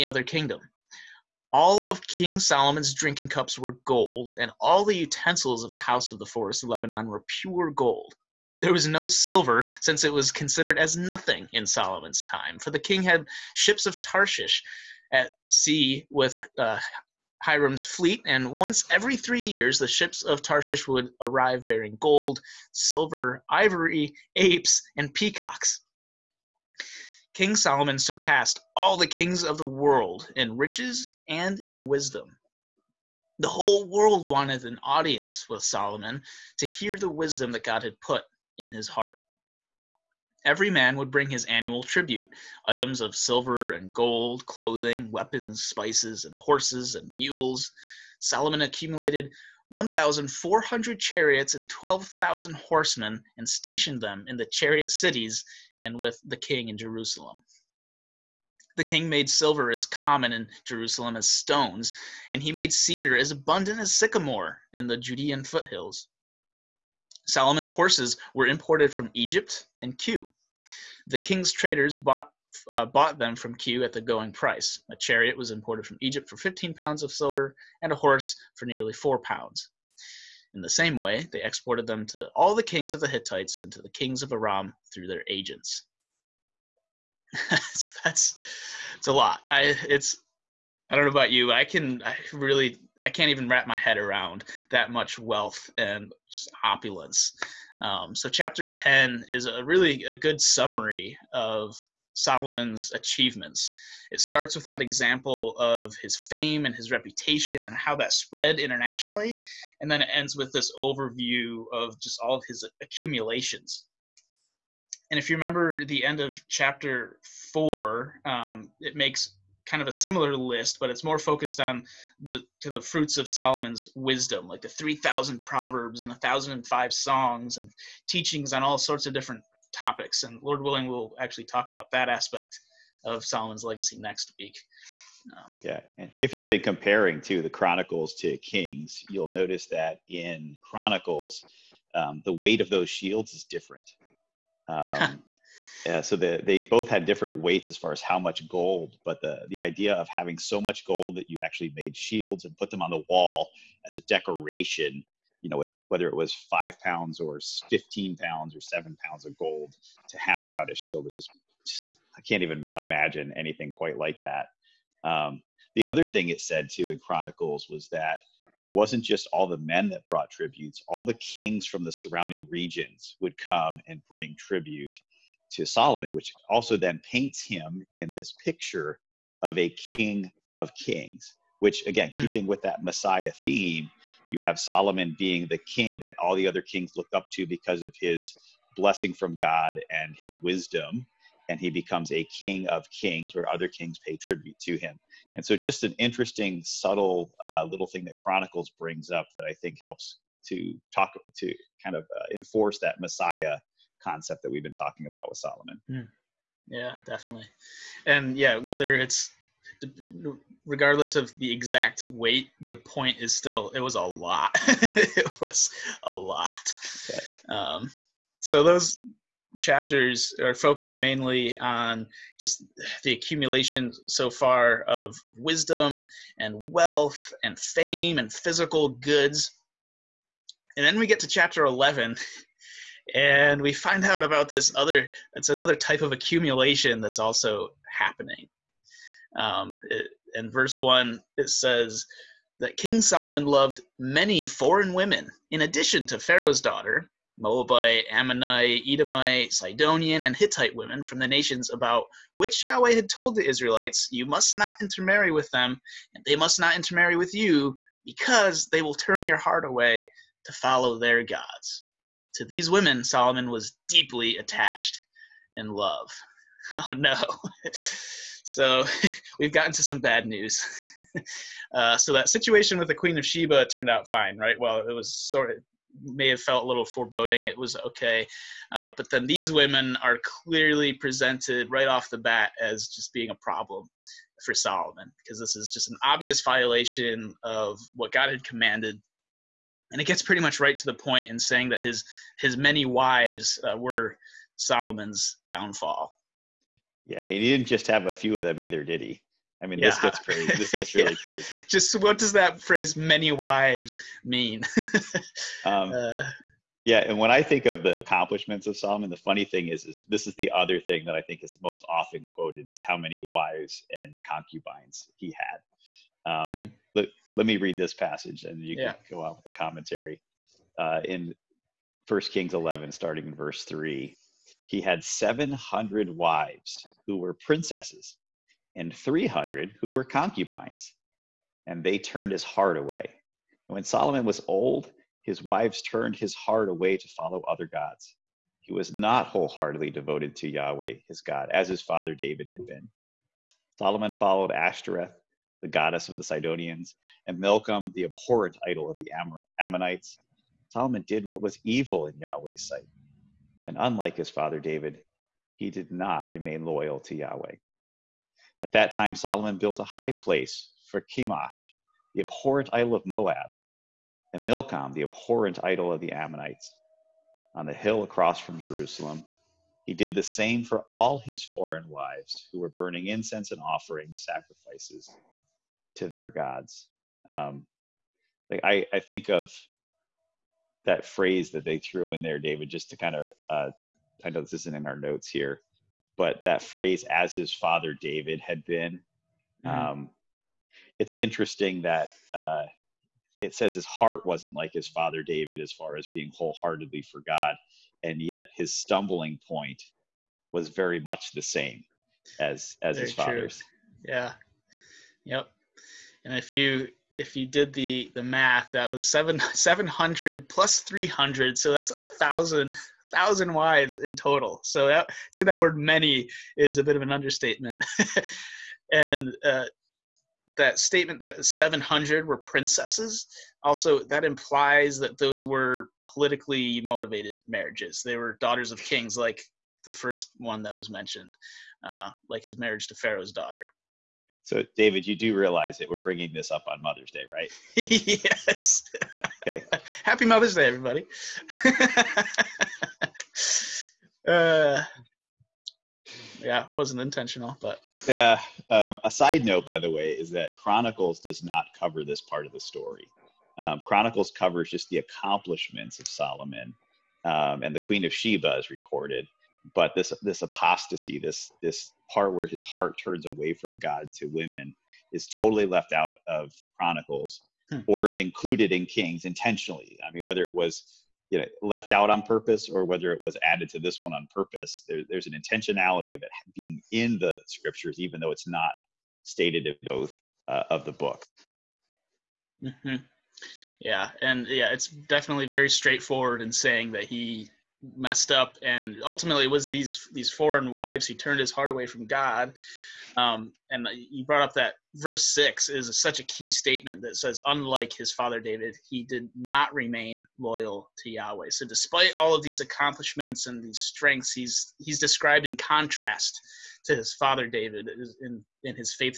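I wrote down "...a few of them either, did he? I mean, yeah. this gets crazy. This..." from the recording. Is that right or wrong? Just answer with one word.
right.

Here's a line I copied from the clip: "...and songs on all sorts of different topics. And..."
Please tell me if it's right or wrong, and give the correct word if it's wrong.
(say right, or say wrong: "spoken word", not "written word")
wrong: "teachings", not "songs".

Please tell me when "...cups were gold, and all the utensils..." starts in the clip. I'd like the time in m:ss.
0:03.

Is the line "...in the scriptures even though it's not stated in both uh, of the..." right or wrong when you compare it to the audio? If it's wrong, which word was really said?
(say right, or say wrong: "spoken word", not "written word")
right.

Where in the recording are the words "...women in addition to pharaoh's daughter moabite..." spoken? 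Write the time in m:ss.
4:04.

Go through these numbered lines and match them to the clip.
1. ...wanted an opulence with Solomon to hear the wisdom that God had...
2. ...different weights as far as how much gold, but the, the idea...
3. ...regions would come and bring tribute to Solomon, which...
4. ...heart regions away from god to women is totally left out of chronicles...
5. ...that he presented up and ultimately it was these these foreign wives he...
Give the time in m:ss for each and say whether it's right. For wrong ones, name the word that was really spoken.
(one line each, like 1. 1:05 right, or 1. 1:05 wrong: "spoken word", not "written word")
1. 0:34 wrong: "audience", not "opulence"
2. 2:27 right
3. 2:52 right
4. 7:42 wrong: "turns", not "regions"
5. 8:06 wrong: "messed", not "presented".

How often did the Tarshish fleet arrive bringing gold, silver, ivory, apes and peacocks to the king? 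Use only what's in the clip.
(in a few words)
Once every 3 years.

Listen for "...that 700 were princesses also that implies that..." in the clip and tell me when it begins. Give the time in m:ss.
7:01.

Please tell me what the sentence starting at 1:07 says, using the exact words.
Solomon's horses were imported from Egypt and Kue.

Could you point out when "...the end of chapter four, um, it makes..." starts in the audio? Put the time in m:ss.
1:55.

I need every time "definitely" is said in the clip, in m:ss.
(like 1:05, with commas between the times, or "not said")
3:27, 8:04.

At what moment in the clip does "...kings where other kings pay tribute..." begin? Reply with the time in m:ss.
3:12.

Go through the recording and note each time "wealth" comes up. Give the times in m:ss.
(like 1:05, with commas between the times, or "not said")
1:35, 3:46.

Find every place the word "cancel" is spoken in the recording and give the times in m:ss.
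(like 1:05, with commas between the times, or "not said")
not said.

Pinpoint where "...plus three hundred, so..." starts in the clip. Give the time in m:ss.
6:50.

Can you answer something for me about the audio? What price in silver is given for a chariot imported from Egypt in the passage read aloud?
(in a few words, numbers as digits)
15 pounds.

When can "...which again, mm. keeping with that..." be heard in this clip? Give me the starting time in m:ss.
3:01.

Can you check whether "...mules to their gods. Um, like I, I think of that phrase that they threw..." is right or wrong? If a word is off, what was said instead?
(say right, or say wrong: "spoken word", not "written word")
wrong: "sacrifices", not "mules".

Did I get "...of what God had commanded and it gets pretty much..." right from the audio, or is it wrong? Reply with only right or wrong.
right.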